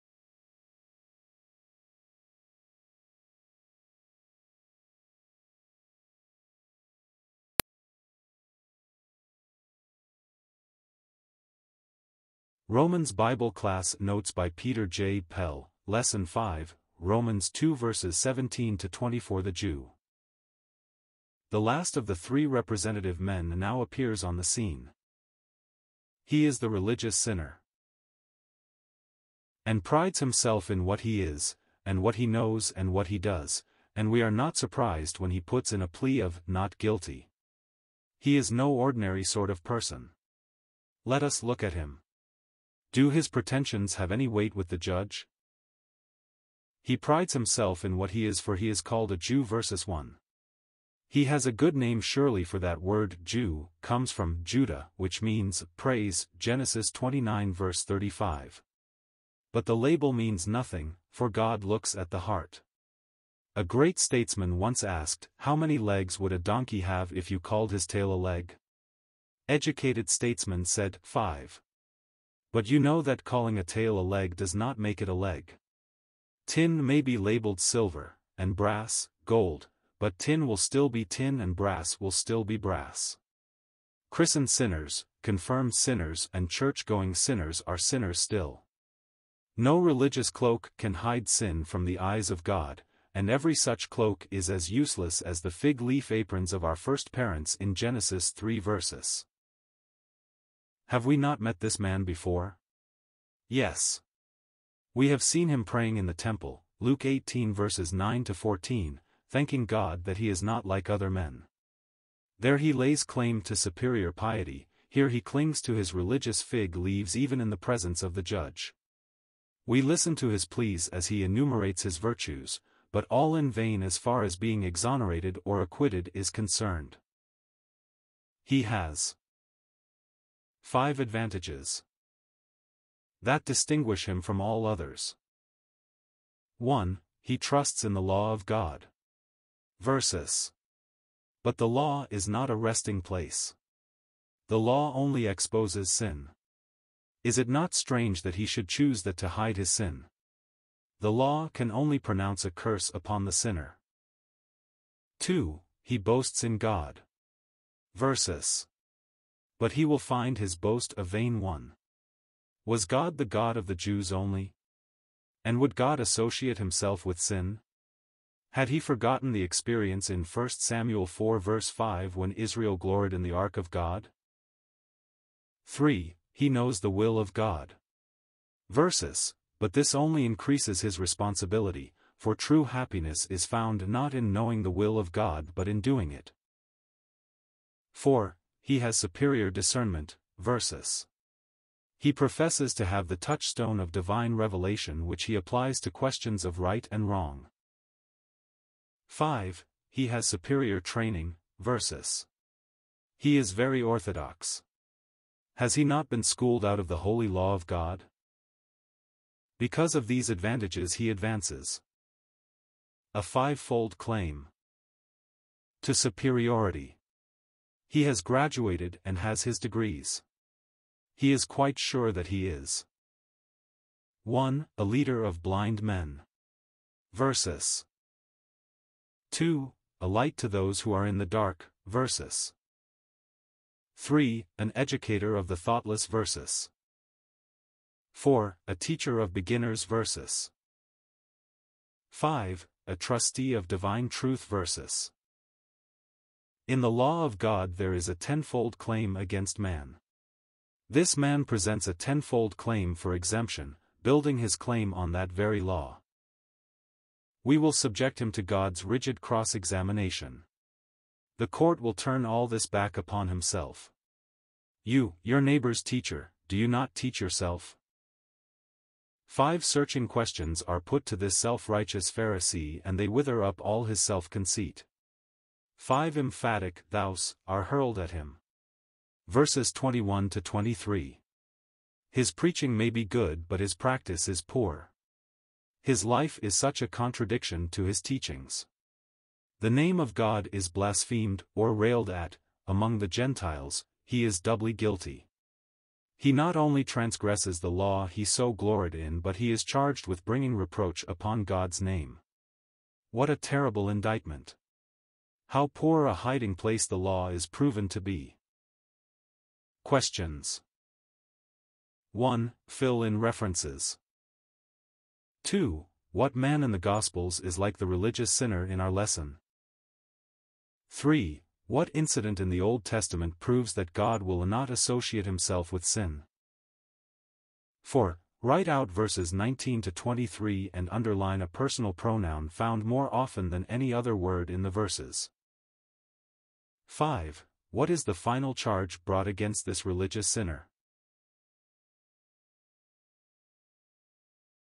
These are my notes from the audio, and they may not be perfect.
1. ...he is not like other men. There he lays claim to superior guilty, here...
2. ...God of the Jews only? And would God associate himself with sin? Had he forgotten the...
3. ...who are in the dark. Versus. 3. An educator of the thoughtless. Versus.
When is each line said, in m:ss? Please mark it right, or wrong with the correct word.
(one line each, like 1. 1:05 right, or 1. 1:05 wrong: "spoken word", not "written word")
1. 1:50 wrong: "piety", not "guilty"
2. 2:43 right
3. 3:50 right.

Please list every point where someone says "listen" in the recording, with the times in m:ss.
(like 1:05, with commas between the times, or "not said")
1:59.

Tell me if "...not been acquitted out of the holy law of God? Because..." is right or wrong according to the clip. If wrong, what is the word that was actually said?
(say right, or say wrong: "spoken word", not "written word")
wrong: "schooled", not "acquitted".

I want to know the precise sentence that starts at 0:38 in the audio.
He is no ordinary sort of person.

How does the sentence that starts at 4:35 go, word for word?
Five emphatic thous are hurled at him.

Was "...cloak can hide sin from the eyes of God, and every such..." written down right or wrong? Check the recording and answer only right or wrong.
right.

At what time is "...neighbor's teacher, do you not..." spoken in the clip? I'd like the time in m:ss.
4:25.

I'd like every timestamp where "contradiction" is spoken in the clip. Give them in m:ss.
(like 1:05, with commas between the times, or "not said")
4:46.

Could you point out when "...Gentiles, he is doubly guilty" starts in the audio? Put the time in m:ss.
4:53.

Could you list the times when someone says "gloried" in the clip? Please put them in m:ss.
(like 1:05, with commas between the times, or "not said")
2:52, 4:58.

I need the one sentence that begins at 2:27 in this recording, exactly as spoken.
Is it not strange that he should choose that to hide his sin?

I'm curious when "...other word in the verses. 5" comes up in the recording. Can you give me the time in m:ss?
5:33.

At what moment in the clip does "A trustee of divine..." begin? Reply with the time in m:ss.
4:02.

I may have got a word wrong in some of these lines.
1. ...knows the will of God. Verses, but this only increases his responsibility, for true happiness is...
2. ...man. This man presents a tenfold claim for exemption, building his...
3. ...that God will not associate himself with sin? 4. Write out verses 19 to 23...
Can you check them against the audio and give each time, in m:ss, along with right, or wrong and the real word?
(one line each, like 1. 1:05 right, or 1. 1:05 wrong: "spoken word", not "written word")
1. 2:56 right
2. 4:09 right
3. 5:23 right.